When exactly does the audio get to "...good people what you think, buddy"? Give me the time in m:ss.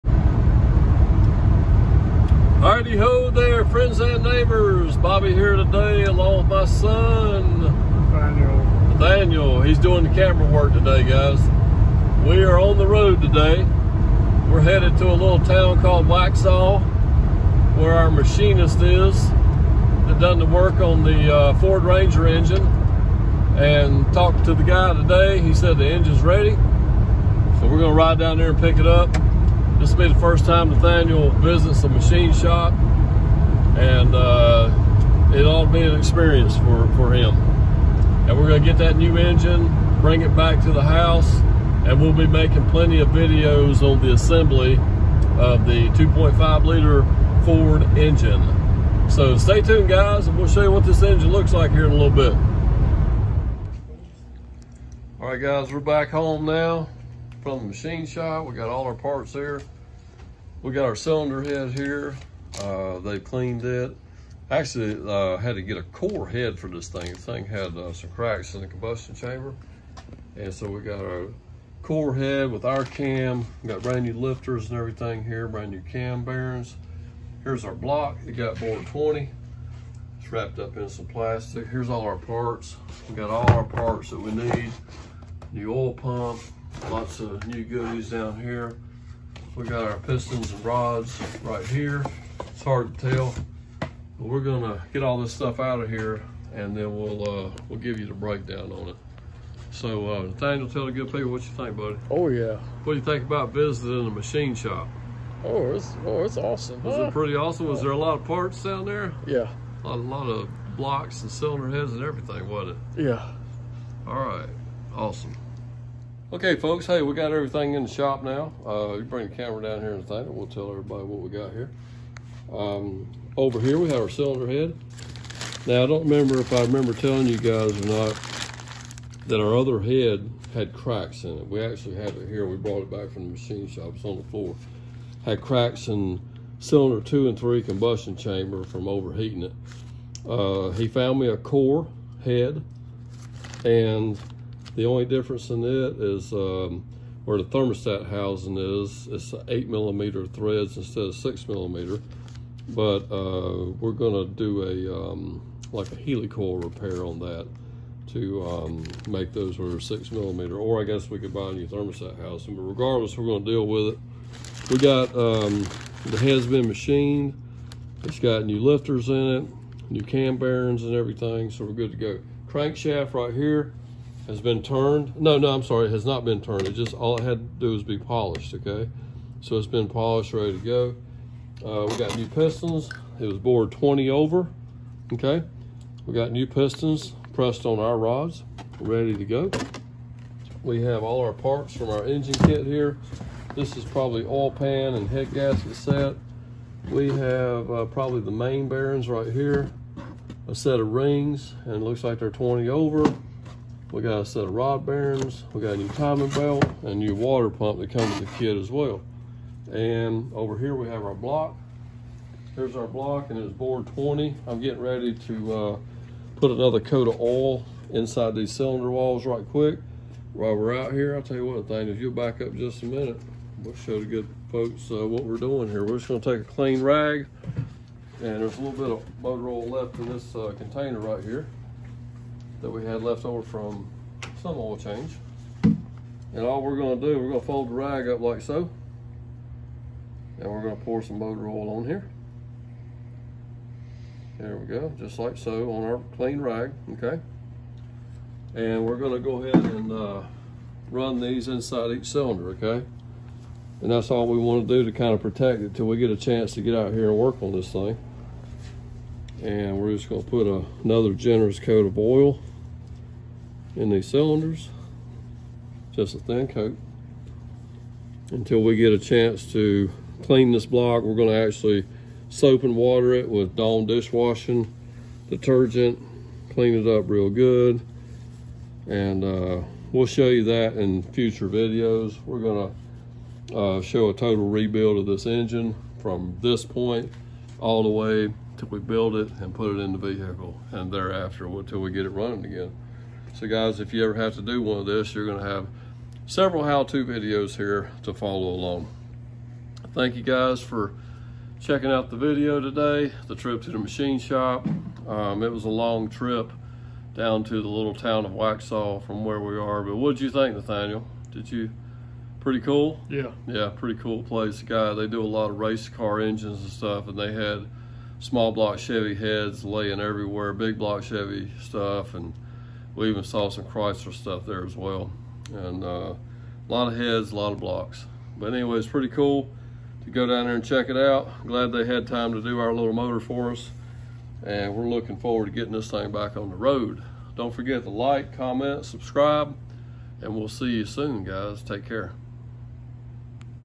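1:40.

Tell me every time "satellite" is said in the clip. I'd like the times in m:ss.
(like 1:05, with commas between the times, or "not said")
not said.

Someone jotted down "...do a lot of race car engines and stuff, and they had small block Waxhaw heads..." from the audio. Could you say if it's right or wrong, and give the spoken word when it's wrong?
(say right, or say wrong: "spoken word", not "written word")
wrong: "Chevy", not "Waxhaw".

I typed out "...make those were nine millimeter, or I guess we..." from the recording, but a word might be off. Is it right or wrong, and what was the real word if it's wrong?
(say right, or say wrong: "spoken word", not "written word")
wrong: "six", not "nine".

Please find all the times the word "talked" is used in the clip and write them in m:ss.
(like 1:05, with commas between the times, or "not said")
0:24.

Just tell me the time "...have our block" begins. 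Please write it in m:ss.
3:30.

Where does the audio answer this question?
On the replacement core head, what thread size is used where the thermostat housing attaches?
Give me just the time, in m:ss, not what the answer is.
2:29.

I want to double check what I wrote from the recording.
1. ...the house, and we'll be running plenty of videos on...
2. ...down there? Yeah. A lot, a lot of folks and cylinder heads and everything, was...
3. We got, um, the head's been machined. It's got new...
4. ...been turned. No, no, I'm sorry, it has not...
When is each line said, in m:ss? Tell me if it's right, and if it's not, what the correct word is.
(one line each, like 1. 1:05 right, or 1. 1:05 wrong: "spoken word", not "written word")
1. 0:40 wrong: "making", not "running"
2. 1:48 wrong: "blocks", not "folks"
3. 2:44 right
4. 2:54 right.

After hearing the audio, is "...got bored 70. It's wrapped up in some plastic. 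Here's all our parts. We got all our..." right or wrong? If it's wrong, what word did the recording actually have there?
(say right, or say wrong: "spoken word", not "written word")
wrong: "20", not "70".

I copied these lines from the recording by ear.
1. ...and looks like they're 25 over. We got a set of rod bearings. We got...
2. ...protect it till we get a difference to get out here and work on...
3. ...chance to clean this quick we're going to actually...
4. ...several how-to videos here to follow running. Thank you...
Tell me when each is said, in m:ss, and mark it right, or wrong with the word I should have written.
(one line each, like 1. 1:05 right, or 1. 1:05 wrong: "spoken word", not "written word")
1. 3:21 wrong: "20", not "25"
2. 4:15 wrong: "chance", not "difference"
3. 4:28 wrong: "block", not "quick"
4. 4:56 wrong: "along", not "running".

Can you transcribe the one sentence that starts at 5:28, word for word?
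But anyway, it's pretty cool to go down there and check it out.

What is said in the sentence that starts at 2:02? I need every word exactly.
Um, over here, we have our cylinder head.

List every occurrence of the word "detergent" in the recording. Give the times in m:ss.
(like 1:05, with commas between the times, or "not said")
4:35.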